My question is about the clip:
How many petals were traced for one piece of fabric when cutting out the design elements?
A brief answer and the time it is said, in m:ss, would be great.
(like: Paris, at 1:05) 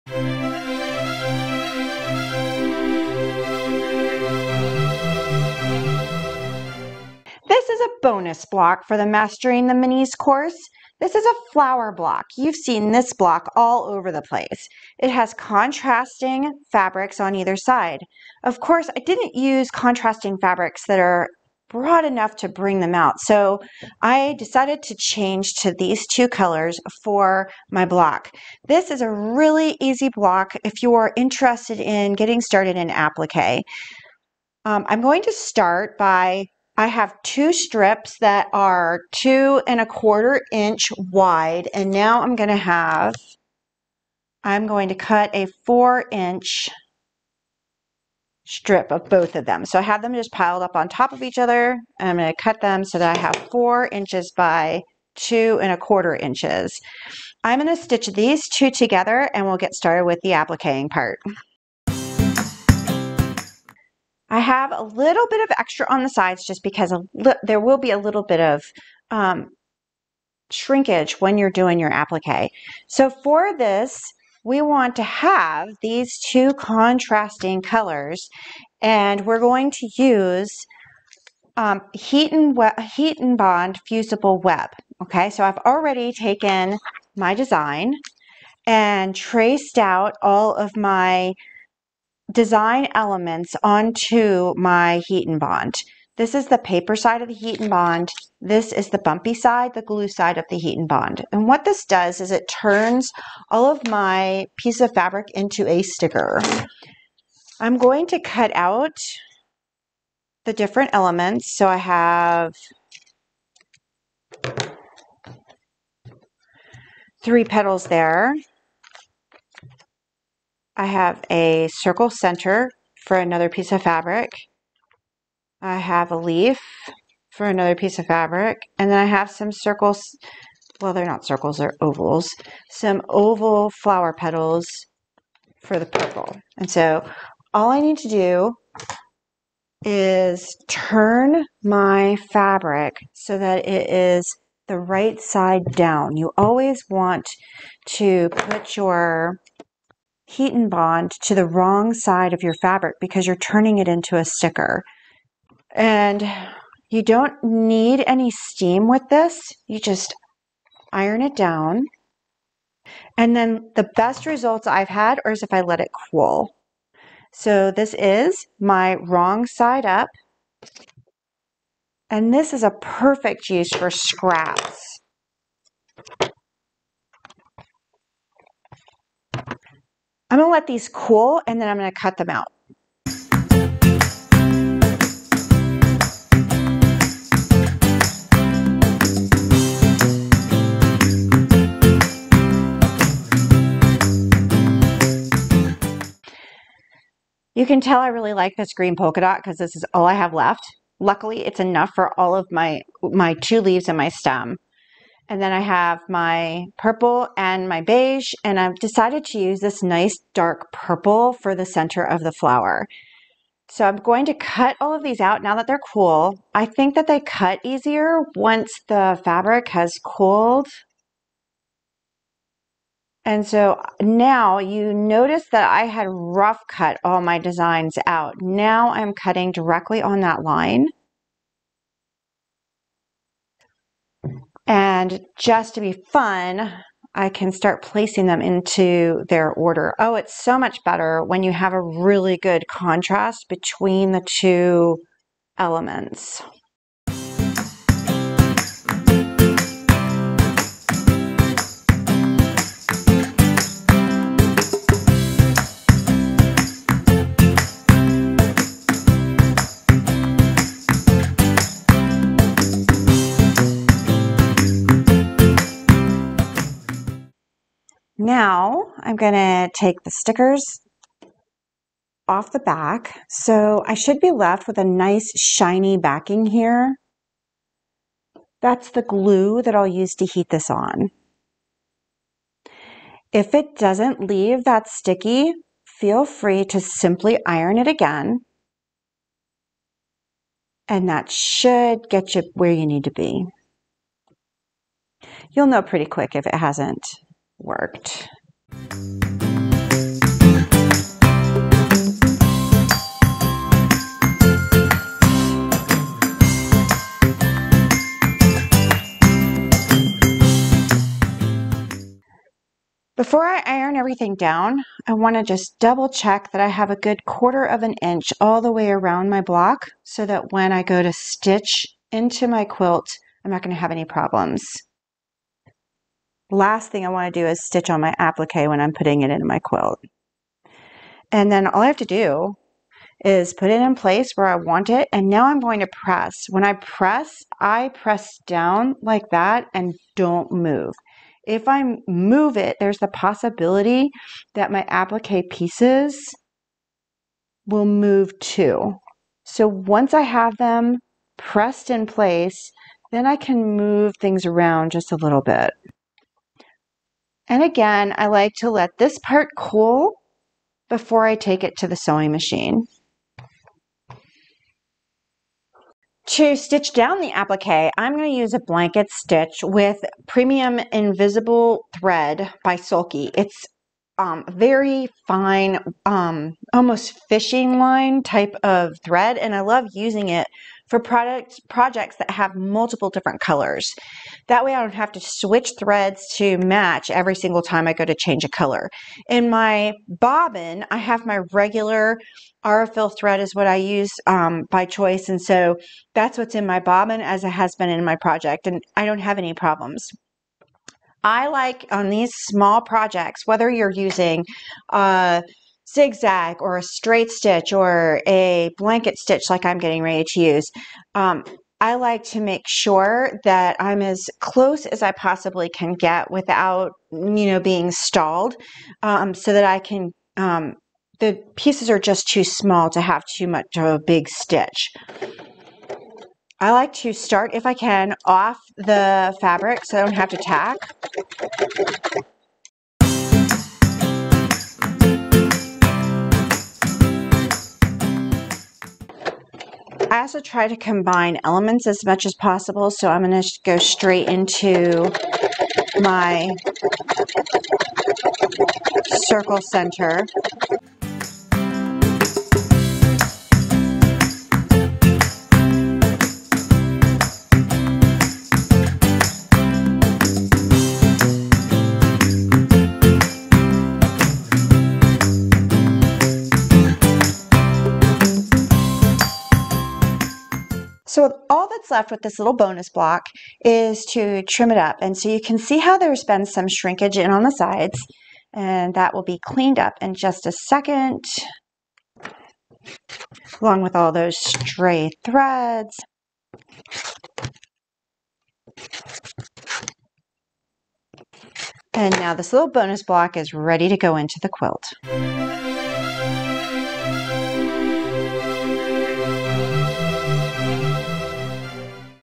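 3, at 1:57.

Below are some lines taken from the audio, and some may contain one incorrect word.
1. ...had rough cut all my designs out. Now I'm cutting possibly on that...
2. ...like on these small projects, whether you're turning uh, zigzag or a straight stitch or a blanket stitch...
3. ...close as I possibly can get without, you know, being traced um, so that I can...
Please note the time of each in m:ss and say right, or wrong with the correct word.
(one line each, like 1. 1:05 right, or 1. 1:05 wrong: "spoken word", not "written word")
1. 3:45 wrong: "directly", not "possibly"
2. 6:41 wrong: "using", not "turning"
3. 6:54 wrong: "stalled", not "traced".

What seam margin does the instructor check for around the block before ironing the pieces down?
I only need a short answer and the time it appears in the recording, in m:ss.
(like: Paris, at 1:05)
a quarter inch, at 5:17.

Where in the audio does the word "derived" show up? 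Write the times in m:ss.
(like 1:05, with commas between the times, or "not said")
not said.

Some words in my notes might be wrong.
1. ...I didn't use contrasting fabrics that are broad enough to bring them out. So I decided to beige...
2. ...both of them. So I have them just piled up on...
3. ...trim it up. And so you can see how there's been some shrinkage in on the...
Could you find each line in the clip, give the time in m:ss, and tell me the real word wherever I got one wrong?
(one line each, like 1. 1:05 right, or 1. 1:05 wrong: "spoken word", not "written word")
1. 0:18 wrong: "change", not "beige"
2. 0:49 right
3. 7:54 right.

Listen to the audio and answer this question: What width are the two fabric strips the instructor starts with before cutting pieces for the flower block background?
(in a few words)
2 1/4 inches.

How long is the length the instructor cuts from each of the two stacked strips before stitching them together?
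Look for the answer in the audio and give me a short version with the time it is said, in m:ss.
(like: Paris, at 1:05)
4 inches, at 0:45.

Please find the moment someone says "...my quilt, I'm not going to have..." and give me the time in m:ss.
5:22.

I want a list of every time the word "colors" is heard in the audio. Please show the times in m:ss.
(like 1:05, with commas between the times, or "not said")
0:26, 1:17, 6:23, 6:28.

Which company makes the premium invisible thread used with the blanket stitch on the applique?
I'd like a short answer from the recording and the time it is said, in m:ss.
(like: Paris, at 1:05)
Sulky, at 6:12.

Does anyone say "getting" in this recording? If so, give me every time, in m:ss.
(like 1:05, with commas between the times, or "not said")
0:32, 6:49.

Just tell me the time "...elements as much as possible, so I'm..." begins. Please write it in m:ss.
7:21.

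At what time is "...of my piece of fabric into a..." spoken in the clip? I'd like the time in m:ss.
1:43.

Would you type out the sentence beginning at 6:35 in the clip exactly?
And so that's what's in my bobbin as it has been in my project.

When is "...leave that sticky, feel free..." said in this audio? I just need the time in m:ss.
4:44.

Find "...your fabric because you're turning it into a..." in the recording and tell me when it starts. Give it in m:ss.
2:32.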